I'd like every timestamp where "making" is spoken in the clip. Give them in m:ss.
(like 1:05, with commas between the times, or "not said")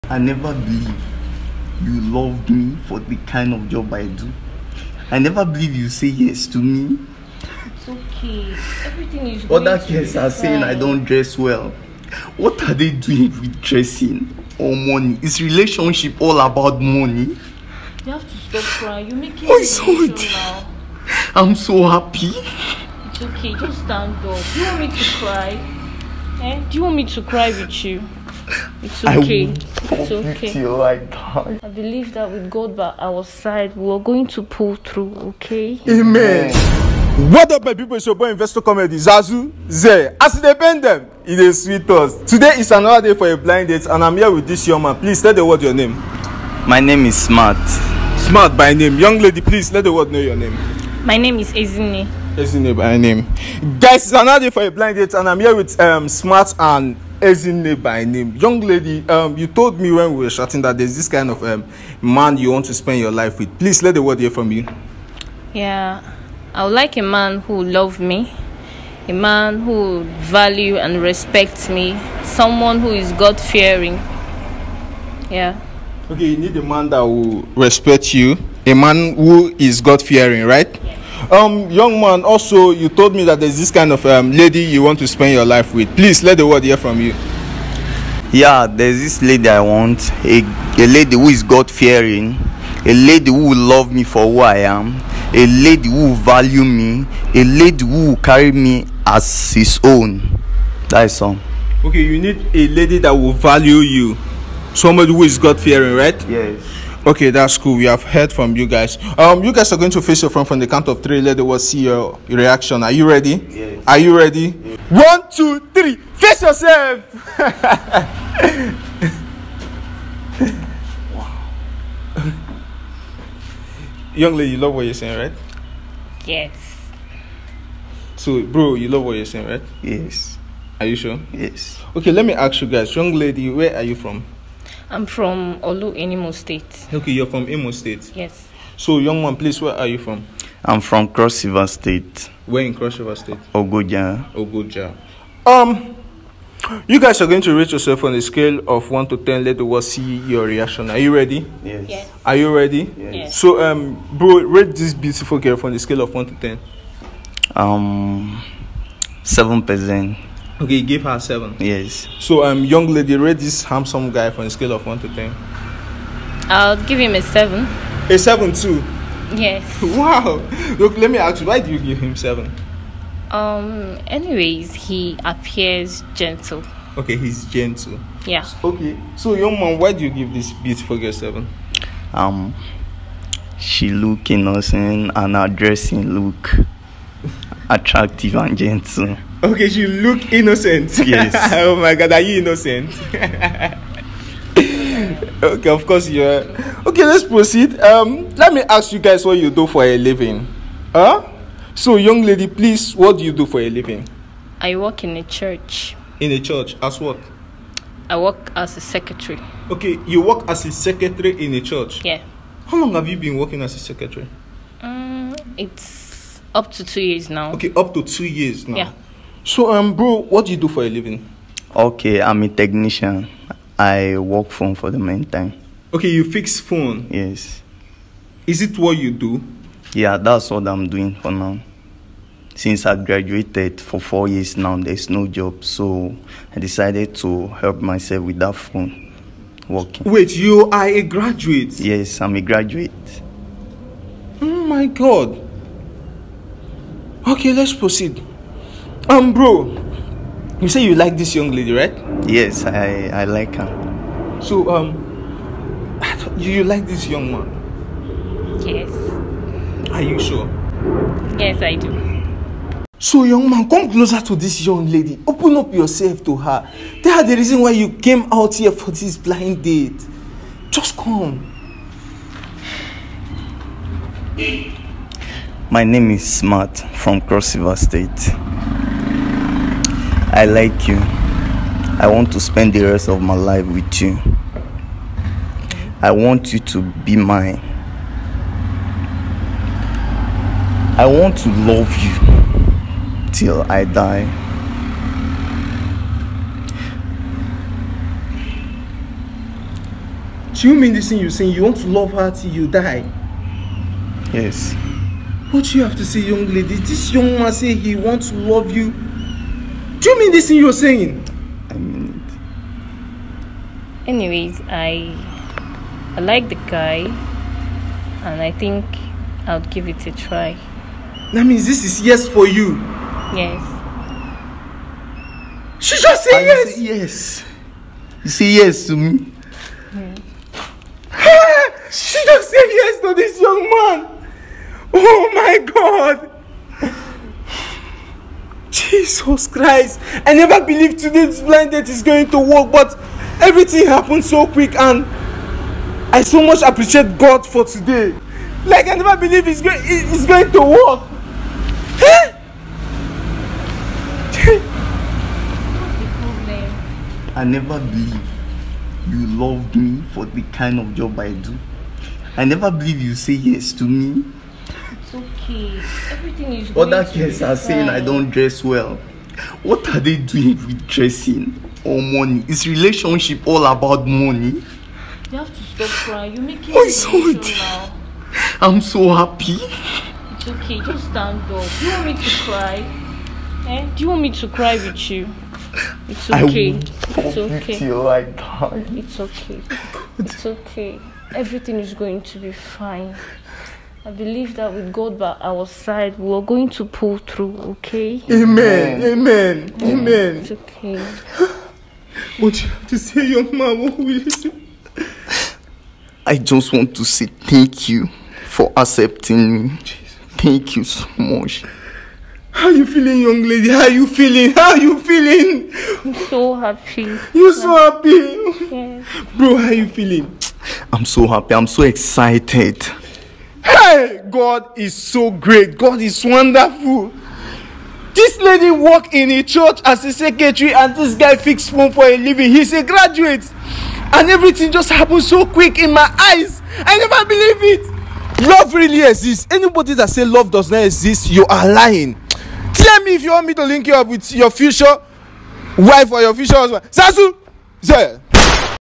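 0:19, 6:16.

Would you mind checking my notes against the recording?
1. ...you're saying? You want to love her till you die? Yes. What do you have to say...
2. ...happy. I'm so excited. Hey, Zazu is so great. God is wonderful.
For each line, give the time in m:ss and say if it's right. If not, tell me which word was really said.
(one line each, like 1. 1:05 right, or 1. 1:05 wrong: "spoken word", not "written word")
1. 5:01 right
2. 7:01 wrong: "God", not "Zazu".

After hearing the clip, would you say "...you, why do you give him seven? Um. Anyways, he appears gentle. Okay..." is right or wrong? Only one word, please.
right.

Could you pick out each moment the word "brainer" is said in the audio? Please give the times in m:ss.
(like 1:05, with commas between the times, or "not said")
not said.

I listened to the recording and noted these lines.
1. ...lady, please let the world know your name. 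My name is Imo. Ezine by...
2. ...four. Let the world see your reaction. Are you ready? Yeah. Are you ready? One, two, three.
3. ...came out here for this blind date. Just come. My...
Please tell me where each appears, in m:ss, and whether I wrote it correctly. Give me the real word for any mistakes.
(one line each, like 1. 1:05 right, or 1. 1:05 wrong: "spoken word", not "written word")
1. 0:49 wrong: "Ezine", not "Imo"
2. 1:51 wrong: "three", not "four"
3. 4:27 right.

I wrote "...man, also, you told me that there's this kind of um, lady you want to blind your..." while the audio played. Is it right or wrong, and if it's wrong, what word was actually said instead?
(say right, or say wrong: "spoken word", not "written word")
wrong: "spend", not "blind".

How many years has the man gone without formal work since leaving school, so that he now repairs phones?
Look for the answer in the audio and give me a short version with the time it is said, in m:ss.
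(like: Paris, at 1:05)
4 years, at 3:53.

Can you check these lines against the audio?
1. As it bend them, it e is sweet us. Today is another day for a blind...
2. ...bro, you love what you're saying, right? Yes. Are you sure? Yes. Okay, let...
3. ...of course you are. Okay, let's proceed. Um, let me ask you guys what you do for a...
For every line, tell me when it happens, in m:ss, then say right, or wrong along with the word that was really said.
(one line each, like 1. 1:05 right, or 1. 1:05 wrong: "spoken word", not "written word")
1. 0:40 right
2. 2:08 right
3. 3:15 right.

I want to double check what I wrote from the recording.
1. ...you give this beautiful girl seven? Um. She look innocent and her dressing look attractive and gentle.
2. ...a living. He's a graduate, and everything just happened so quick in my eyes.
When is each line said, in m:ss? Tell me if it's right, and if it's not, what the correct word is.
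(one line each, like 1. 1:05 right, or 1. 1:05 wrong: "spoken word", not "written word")
1. 3:00 right
2. 7:12 right.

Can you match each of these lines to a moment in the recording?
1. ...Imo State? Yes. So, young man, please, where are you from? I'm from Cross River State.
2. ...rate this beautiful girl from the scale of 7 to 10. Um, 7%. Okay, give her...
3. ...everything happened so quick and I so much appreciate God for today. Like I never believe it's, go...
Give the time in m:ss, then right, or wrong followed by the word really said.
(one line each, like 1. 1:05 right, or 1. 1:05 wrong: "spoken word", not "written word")
1. 2:17 right
2. 2:34 wrong: "1", not "7"
3. 5:43 right.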